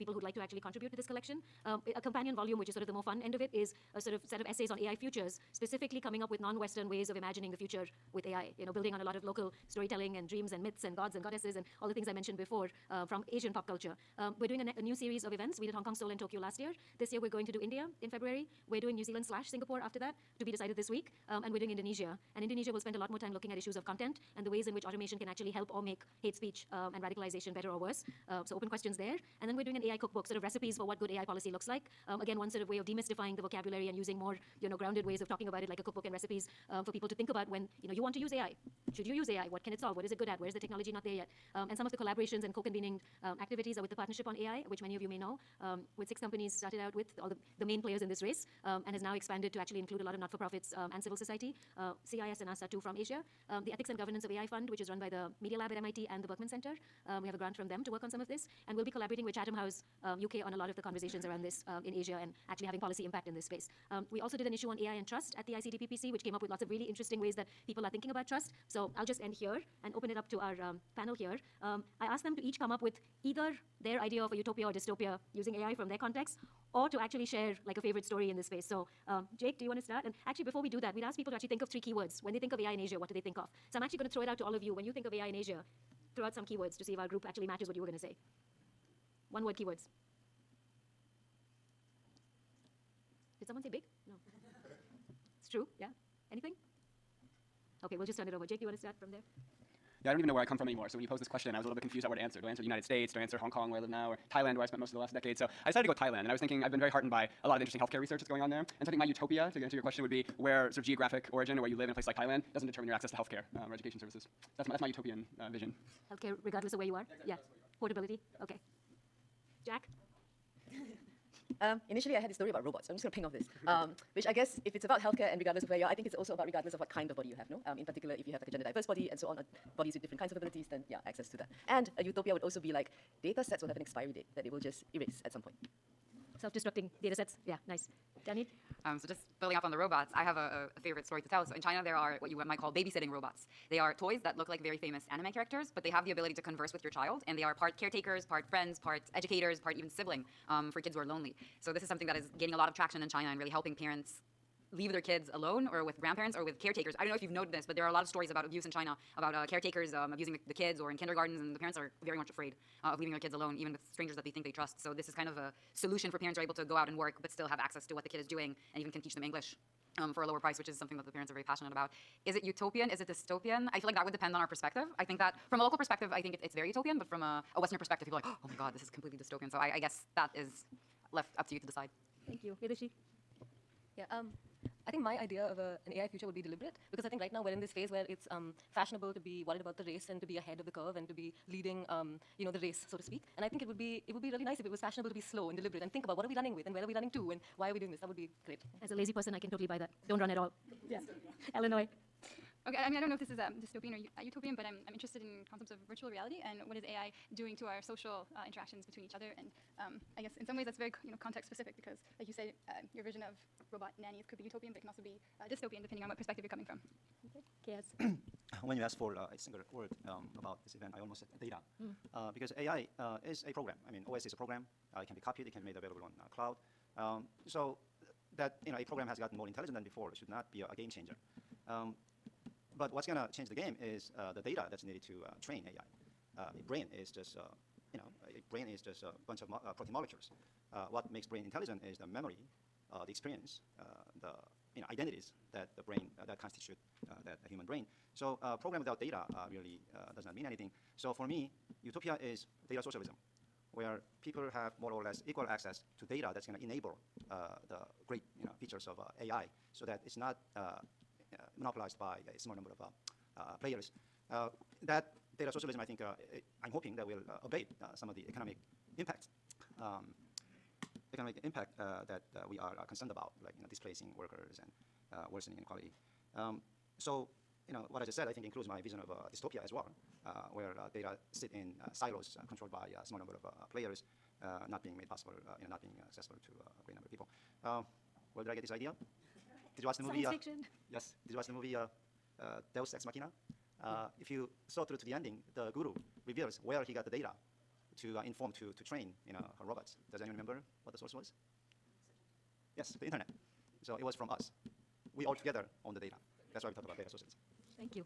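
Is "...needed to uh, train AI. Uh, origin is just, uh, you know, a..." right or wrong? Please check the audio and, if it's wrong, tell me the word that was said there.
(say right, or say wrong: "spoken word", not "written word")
wrong: "brain", not "origin".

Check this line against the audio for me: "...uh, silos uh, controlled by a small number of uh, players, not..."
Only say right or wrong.
right.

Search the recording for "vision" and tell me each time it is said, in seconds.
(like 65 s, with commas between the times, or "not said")
115 s, 213 s, 278 s.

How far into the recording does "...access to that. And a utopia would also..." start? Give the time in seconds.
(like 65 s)
131 s.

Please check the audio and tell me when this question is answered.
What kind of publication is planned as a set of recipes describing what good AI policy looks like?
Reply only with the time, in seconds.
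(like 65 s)
29 s.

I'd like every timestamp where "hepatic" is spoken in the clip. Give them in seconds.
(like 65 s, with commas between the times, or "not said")
not said.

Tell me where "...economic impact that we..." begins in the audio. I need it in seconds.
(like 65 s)
271 s.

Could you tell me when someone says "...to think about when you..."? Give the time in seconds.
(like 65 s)
37 s.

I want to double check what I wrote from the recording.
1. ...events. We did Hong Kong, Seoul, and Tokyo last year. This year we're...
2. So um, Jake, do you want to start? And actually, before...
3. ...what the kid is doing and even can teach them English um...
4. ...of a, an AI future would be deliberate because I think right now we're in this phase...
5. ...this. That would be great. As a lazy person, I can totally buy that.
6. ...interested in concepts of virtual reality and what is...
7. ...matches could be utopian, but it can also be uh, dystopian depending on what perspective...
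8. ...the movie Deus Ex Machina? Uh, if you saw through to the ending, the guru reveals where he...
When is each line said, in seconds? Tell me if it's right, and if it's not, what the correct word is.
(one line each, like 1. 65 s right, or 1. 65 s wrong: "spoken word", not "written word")
1. 15 s right
2. 78 s right
3. 167 s right
4. 185 s right
5. 197 s right
6. 204 s right
7. 213 s wrong: "nannies", not "matches"
8. 291 s right.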